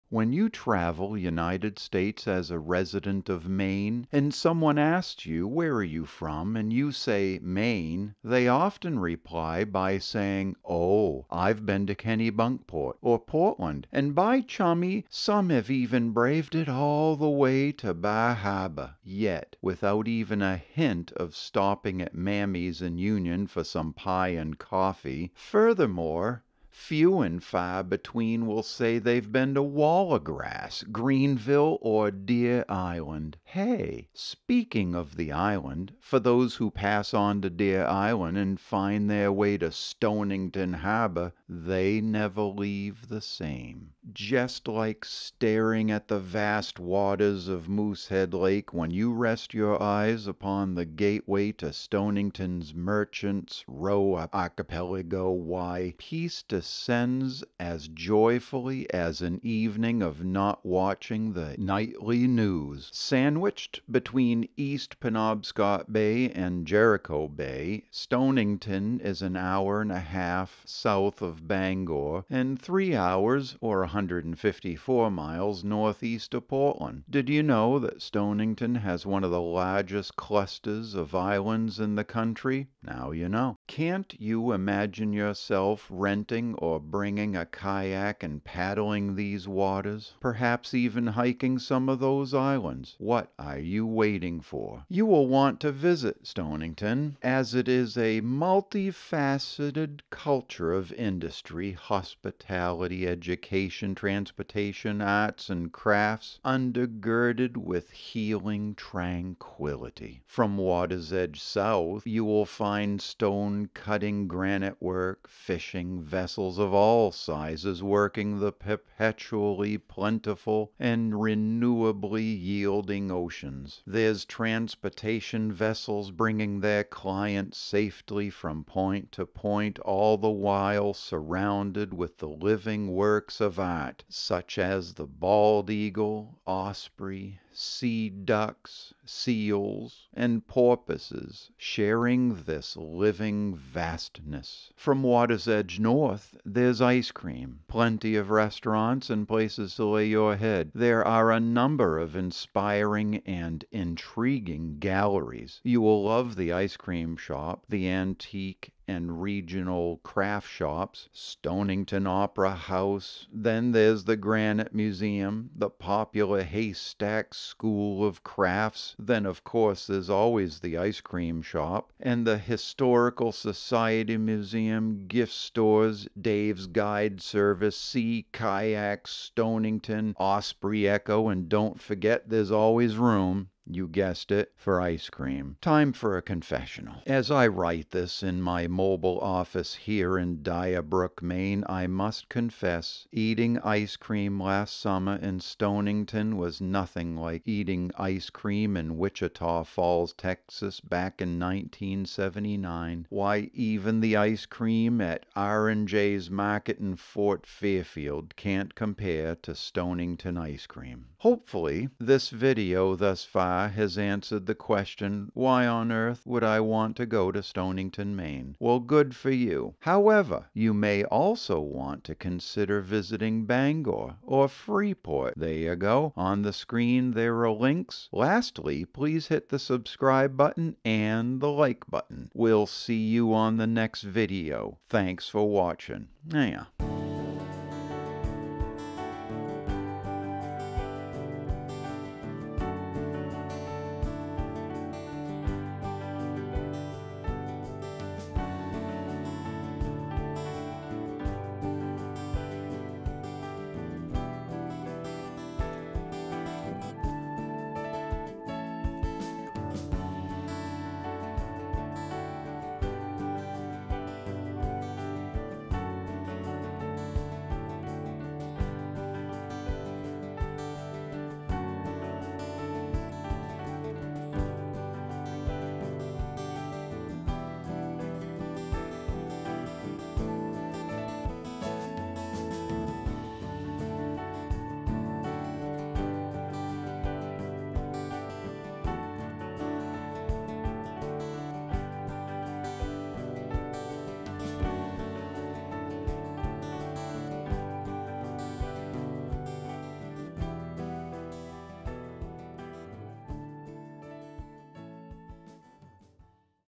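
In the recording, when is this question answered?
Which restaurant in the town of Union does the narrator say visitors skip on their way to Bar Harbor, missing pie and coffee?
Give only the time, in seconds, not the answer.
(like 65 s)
22 s.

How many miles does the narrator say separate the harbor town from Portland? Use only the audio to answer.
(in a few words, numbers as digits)
154.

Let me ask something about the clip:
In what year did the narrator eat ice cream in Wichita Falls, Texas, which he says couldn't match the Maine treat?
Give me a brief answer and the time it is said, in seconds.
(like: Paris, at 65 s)
1979, at 201 s.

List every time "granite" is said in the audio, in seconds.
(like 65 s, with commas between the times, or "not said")
114 s, 164 s.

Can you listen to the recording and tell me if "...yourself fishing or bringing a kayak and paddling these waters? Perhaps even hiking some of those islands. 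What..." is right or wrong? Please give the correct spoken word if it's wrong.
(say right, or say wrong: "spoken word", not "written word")
wrong: "renting", not "fishing".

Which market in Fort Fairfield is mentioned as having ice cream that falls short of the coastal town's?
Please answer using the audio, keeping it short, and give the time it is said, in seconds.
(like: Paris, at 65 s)
R&J's Market, at 205 s.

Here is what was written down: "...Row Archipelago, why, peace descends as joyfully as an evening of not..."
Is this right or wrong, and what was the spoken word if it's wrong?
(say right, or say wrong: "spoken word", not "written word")
right.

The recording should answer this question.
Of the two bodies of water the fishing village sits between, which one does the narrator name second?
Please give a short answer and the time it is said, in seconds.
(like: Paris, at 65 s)
Jericho Bay, at 66 s.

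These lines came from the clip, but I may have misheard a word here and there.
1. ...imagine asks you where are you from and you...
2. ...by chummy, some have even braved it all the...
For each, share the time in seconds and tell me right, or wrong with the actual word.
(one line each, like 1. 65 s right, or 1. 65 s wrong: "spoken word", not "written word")
1. 4 s wrong: "someone", not "imagine"
2. 14 s right.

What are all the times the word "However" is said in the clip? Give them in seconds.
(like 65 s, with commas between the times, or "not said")
219 s.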